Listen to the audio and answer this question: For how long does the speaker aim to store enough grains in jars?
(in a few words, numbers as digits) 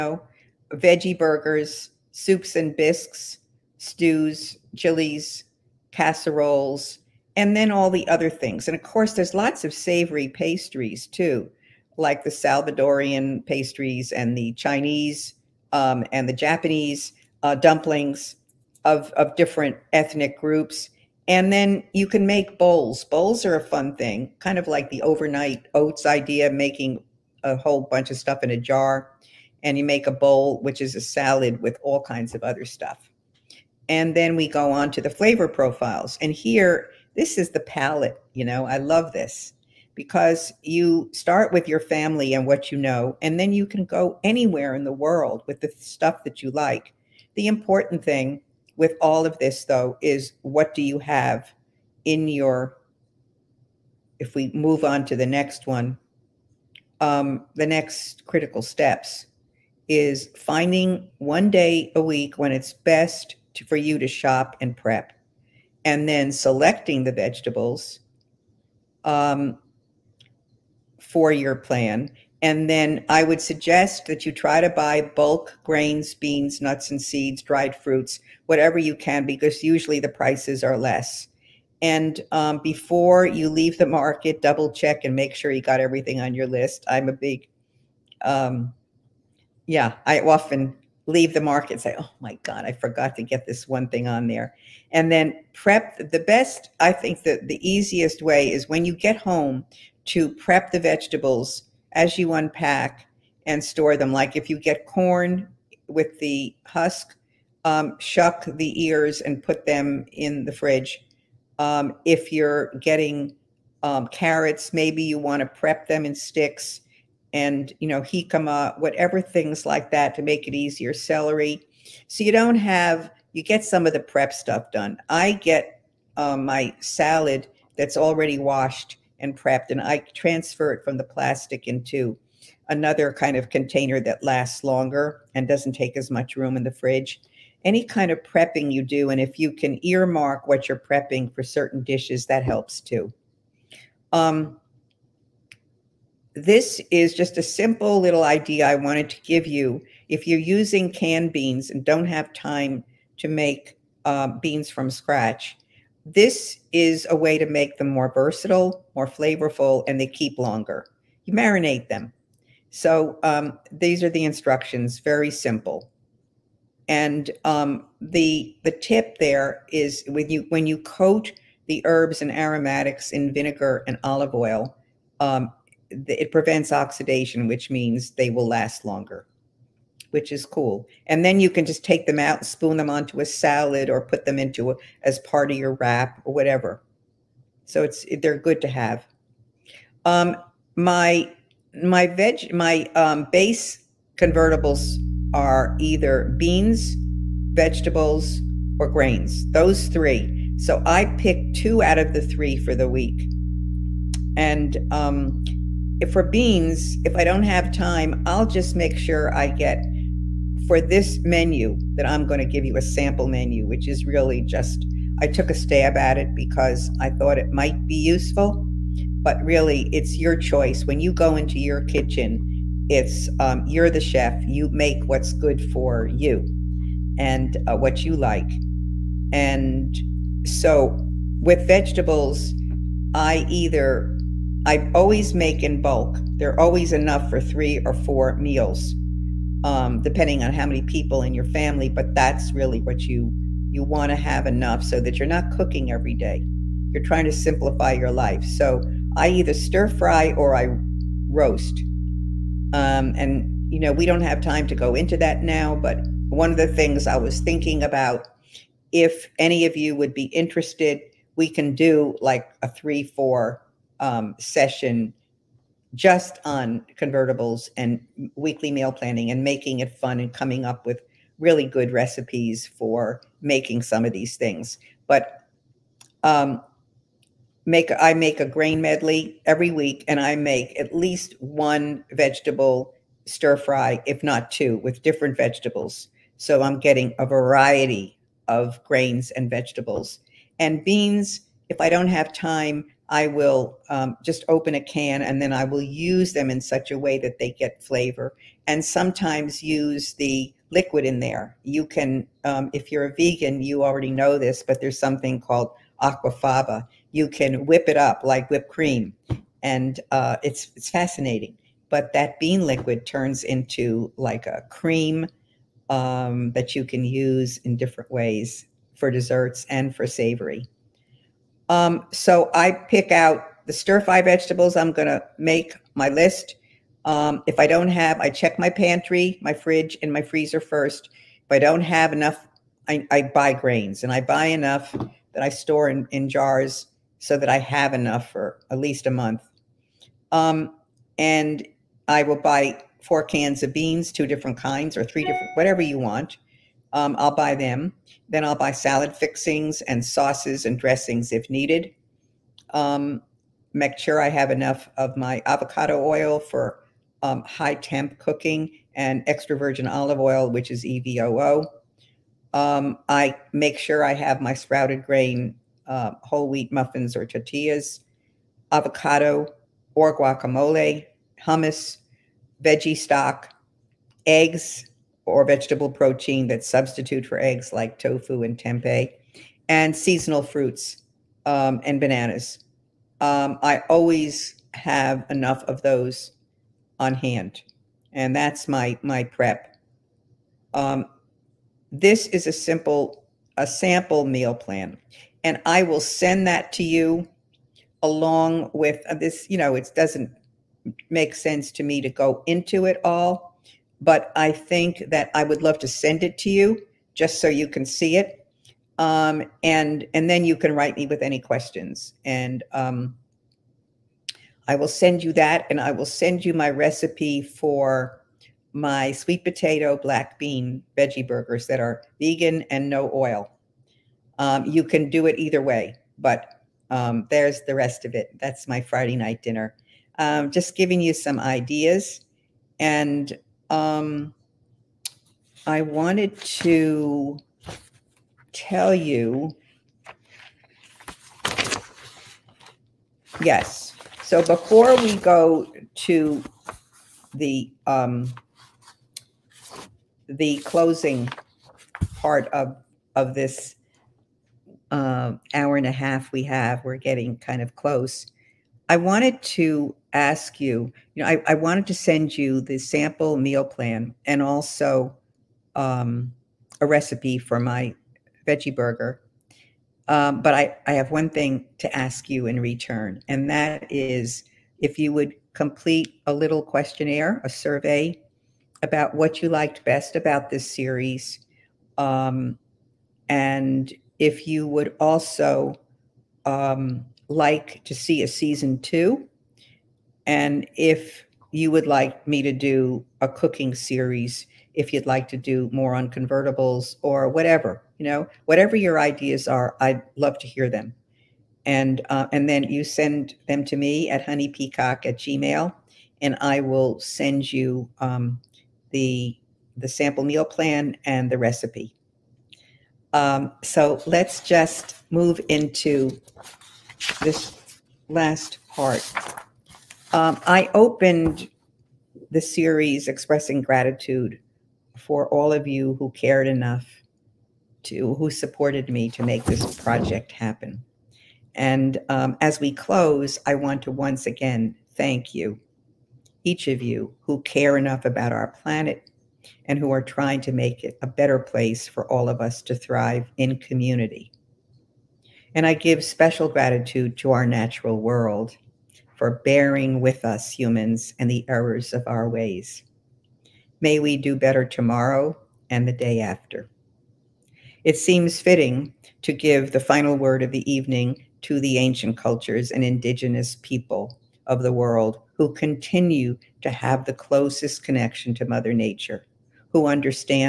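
A month.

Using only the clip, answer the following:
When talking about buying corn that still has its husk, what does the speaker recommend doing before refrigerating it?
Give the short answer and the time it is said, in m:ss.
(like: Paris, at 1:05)
Shuck the ears, at 1:47.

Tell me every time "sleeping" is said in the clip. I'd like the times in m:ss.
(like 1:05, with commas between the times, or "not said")
not said.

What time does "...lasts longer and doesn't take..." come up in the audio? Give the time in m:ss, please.
2:14.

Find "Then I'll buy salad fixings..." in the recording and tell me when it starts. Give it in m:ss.
5:48.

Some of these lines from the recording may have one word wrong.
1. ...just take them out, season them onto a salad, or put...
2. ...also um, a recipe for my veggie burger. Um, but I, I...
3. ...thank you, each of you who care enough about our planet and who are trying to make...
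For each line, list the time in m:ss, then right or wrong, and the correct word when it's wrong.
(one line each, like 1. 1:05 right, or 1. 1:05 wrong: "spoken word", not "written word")
1. 3:01 wrong: "spoon", not "season"
2. 7:44 right
3. 8:54 right.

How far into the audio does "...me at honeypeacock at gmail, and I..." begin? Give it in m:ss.
8:23.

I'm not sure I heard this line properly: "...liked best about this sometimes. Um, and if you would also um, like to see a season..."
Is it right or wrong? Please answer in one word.
wrong.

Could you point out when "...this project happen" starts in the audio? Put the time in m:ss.
8:49.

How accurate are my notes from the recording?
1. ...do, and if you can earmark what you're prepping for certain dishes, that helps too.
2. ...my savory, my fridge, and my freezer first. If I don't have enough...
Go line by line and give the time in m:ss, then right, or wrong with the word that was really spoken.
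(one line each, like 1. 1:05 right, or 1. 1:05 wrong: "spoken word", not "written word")
1. 2:18 right
2. 5:28 wrong: "pantry", not "savory".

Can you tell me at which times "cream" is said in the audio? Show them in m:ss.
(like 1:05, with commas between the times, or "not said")
5:08, 5:14.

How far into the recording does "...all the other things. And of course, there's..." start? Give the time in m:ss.
0:07.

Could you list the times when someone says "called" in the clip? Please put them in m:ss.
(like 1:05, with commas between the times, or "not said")
5:05.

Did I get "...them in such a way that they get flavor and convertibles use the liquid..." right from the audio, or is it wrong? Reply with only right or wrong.
wrong.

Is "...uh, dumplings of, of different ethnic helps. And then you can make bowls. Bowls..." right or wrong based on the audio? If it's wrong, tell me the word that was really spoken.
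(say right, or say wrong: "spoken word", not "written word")
wrong: "groups", not "helps".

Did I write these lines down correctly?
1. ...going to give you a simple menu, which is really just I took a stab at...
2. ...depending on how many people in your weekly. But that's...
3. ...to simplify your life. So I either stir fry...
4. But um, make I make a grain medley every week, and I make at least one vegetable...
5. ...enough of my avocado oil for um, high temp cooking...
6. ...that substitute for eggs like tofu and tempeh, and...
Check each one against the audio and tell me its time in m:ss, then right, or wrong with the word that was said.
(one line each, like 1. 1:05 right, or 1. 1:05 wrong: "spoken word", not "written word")
1. 3:32 wrong: "sample", not "simple"
2. 4:00 wrong: "family", not "weekly"
3. 4:07 right
4. 4:35 right
5. 5:54 right
6. 6:16 right.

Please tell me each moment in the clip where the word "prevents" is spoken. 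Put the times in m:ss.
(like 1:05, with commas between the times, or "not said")
2:56.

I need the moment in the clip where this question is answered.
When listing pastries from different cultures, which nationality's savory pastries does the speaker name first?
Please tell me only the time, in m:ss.
0:12.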